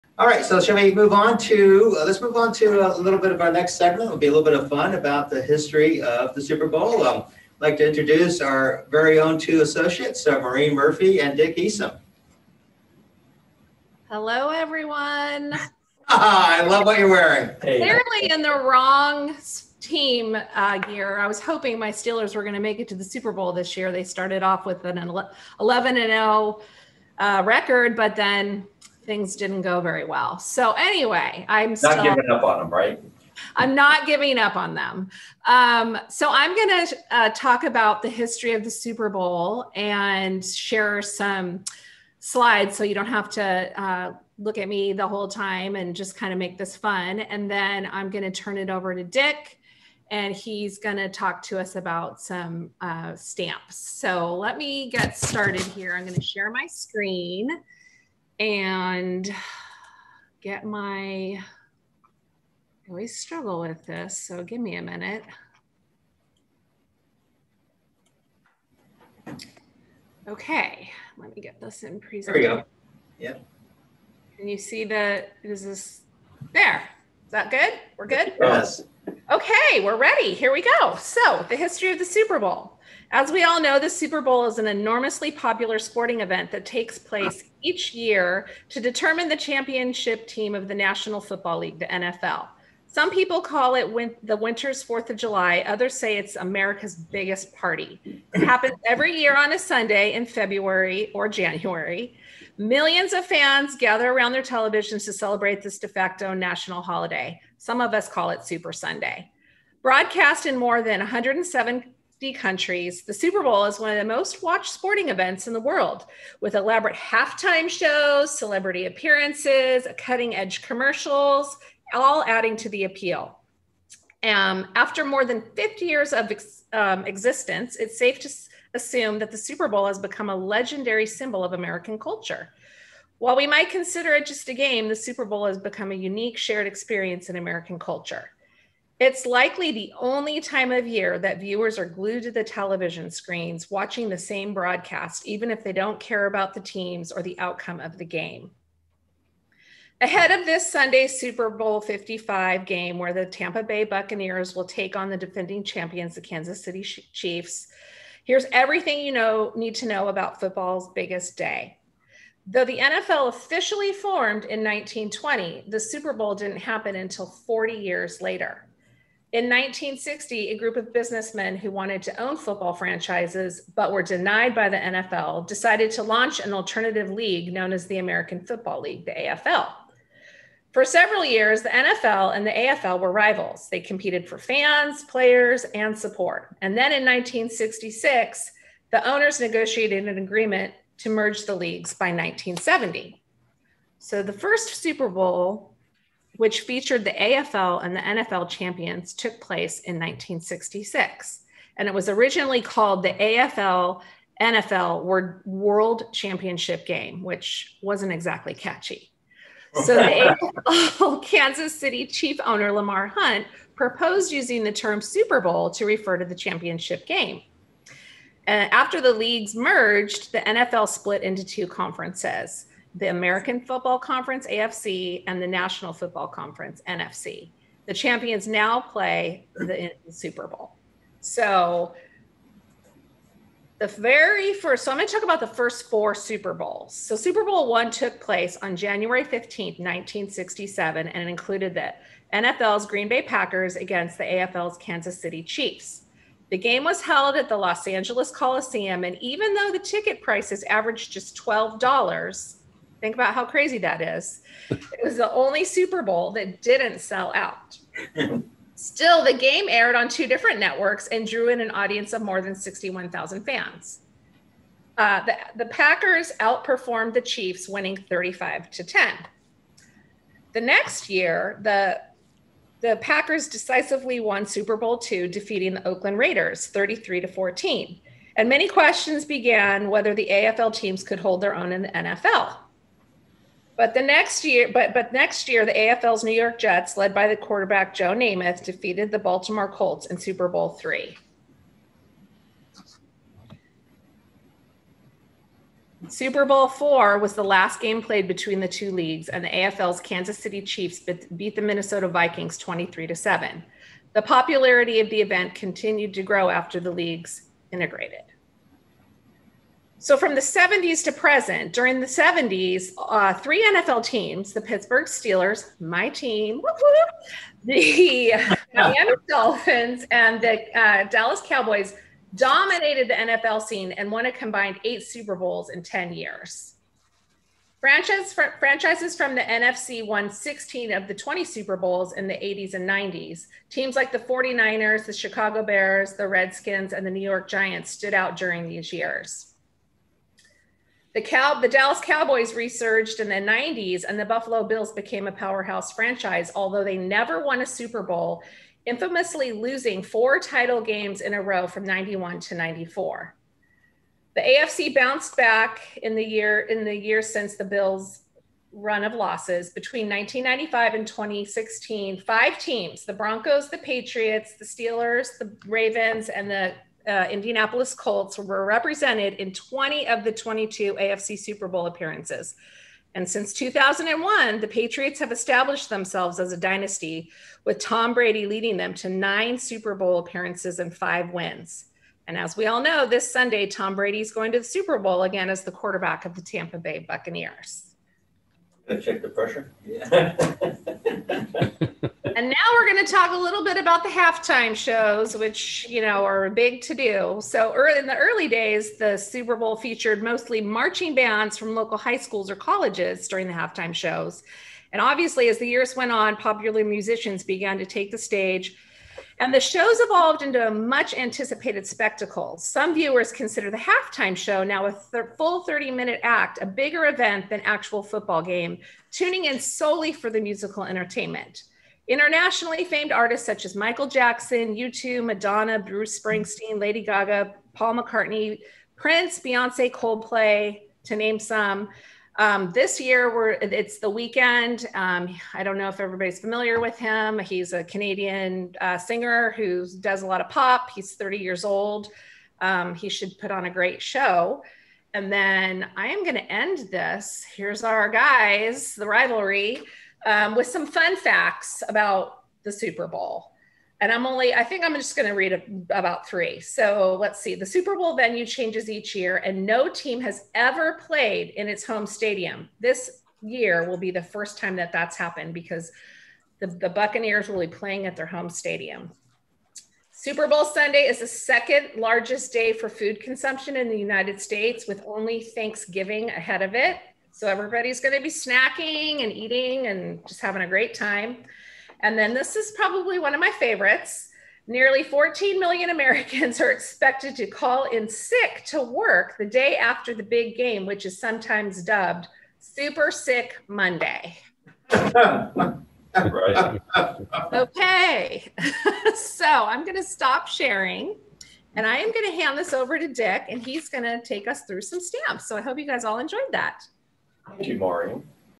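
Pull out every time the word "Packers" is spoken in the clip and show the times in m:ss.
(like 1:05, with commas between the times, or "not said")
4:03, 4:25, 4:32.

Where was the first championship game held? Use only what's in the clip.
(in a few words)
Los Angeles Coliseum.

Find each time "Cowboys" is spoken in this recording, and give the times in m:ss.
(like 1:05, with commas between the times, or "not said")
5:21, 5:41.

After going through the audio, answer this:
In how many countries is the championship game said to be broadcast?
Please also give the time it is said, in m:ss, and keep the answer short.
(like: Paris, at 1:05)
more than 107, at 1:50.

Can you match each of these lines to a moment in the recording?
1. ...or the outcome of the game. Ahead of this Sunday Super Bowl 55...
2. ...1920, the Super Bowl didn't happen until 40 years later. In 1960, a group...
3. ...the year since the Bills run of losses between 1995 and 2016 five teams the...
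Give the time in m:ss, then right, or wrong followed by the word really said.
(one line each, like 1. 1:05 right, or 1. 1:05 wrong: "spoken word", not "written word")
1. 2:27 right
2. 2:44 right
3. 5:56 right.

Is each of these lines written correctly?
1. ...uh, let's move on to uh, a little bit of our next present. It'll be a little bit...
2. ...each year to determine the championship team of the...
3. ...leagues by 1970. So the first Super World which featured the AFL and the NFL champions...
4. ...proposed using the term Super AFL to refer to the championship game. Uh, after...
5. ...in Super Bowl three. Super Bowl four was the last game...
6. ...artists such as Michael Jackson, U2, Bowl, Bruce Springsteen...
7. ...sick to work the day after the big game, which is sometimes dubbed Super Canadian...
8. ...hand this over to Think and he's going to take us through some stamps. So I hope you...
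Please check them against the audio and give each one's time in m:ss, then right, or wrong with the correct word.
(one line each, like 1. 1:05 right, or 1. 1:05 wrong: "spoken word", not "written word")
1. 0:01 wrong: "segment", not "present"
2. 1:27 right
3. 3:11 wrong: "Bowl", not "World"
4. 3:33 wrong: "Bowl", not "AFL"
5. 4:50 right
6. 7:03 wrong: "Madonna", not "Bowl"
7. 8:08 wrong: "Sick", not "Canadian"
8. 8:22 wrong: "Dick", not "Think".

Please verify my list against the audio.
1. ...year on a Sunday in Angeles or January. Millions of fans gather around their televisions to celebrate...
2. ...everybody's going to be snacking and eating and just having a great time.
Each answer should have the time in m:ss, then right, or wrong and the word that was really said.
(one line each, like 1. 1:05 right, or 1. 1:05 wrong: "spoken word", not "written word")
1. 1:39 wrong: "February", not "Angeles"
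2. 7:57 right.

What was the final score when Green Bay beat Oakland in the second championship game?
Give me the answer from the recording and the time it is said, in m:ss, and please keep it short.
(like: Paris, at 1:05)
33 to 14, at 4:36.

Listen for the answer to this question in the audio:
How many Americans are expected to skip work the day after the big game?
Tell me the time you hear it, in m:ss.
8:04.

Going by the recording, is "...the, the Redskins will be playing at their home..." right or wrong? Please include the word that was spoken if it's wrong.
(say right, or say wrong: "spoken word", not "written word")
wrong: "Buccaneers", not "Redskins".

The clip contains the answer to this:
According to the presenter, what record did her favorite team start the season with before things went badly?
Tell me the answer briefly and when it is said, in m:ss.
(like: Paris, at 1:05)
11 and 0, at 0:25.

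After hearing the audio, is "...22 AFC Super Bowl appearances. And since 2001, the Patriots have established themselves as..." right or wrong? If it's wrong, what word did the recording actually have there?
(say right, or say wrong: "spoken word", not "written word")
right.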